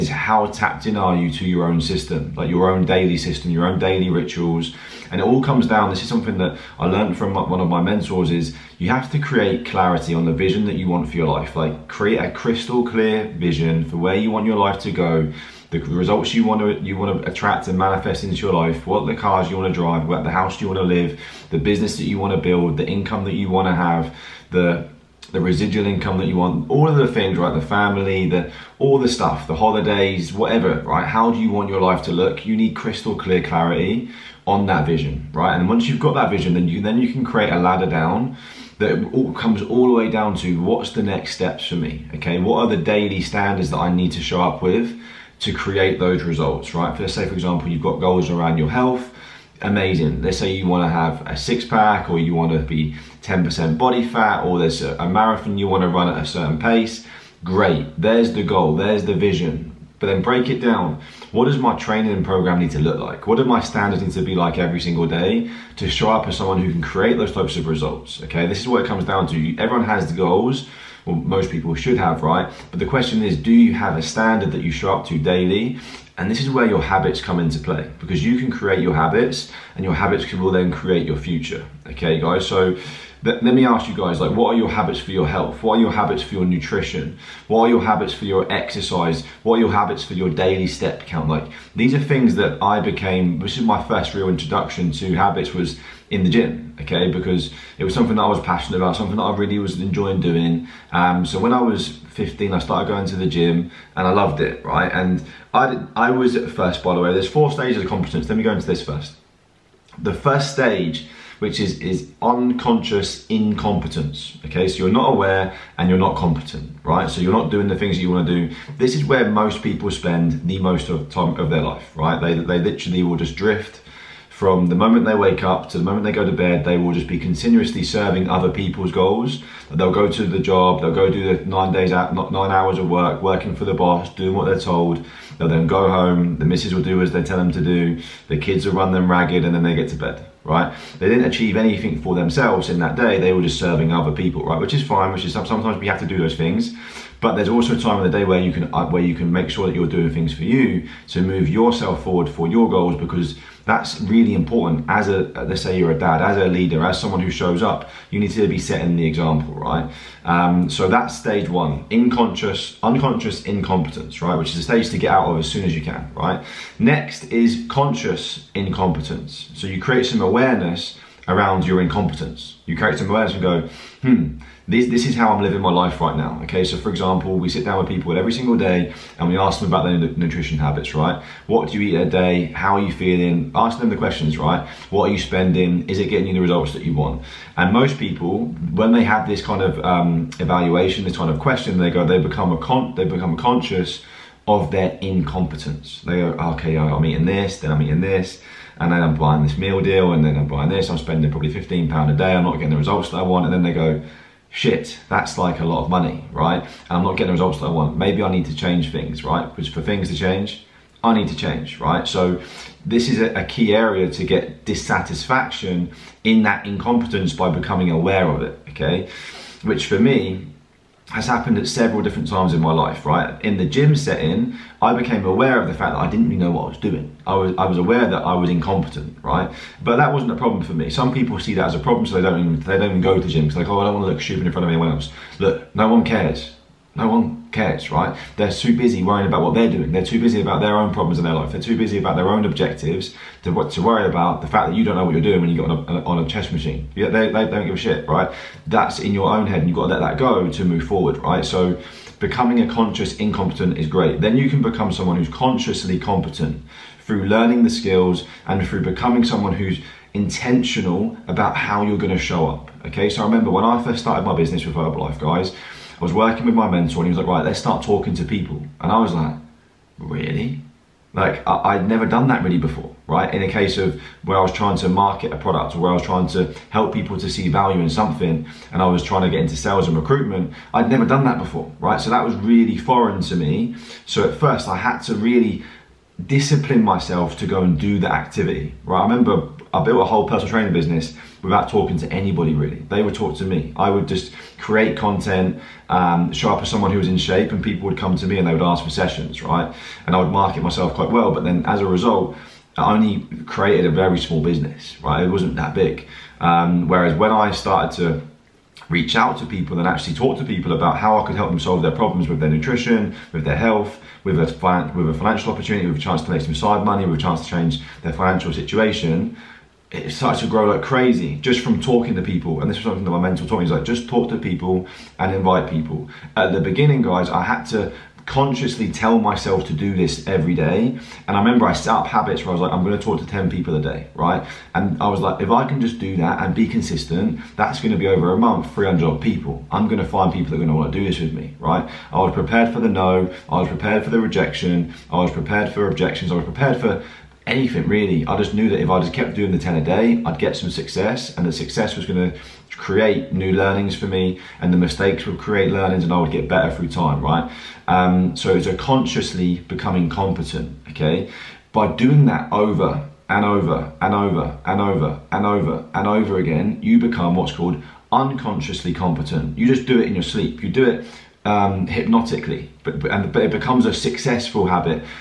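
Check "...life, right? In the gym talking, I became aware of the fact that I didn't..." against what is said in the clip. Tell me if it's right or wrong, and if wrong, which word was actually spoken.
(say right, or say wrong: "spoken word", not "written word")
wrong: "setting", not "talking".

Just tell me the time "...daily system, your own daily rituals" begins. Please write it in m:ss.
0:02.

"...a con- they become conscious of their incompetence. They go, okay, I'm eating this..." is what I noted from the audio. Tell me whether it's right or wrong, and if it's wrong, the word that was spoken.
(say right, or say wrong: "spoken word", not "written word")
right.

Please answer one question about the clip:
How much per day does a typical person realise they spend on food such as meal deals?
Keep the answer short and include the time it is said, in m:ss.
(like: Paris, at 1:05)
15 pounds, at 3:21.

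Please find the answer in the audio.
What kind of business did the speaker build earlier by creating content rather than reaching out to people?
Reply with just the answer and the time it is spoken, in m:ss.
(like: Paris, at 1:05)
Personal training business, at 4:50.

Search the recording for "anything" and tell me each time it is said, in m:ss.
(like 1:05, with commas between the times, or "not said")
2:21, 5:47.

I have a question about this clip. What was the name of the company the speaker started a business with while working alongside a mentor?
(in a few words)
Herbalife.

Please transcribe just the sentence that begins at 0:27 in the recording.
The family, the all the stuff, the holidays, whatever, right?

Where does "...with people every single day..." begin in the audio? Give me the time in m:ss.
2:57.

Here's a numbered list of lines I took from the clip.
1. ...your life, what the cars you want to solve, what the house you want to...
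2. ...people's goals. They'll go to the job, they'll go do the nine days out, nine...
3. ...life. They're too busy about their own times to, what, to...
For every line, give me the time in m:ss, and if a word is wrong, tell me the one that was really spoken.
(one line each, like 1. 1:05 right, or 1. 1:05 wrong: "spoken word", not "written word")
1. 0:18 wrong: "drive", not "solve"
2. 2:08 right
3. 4:01 wrong: "objectives", not "times".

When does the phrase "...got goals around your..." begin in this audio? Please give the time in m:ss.
0:47.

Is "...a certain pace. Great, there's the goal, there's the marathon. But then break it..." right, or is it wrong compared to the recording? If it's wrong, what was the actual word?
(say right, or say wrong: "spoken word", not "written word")
wrong: "vision", not "marathon".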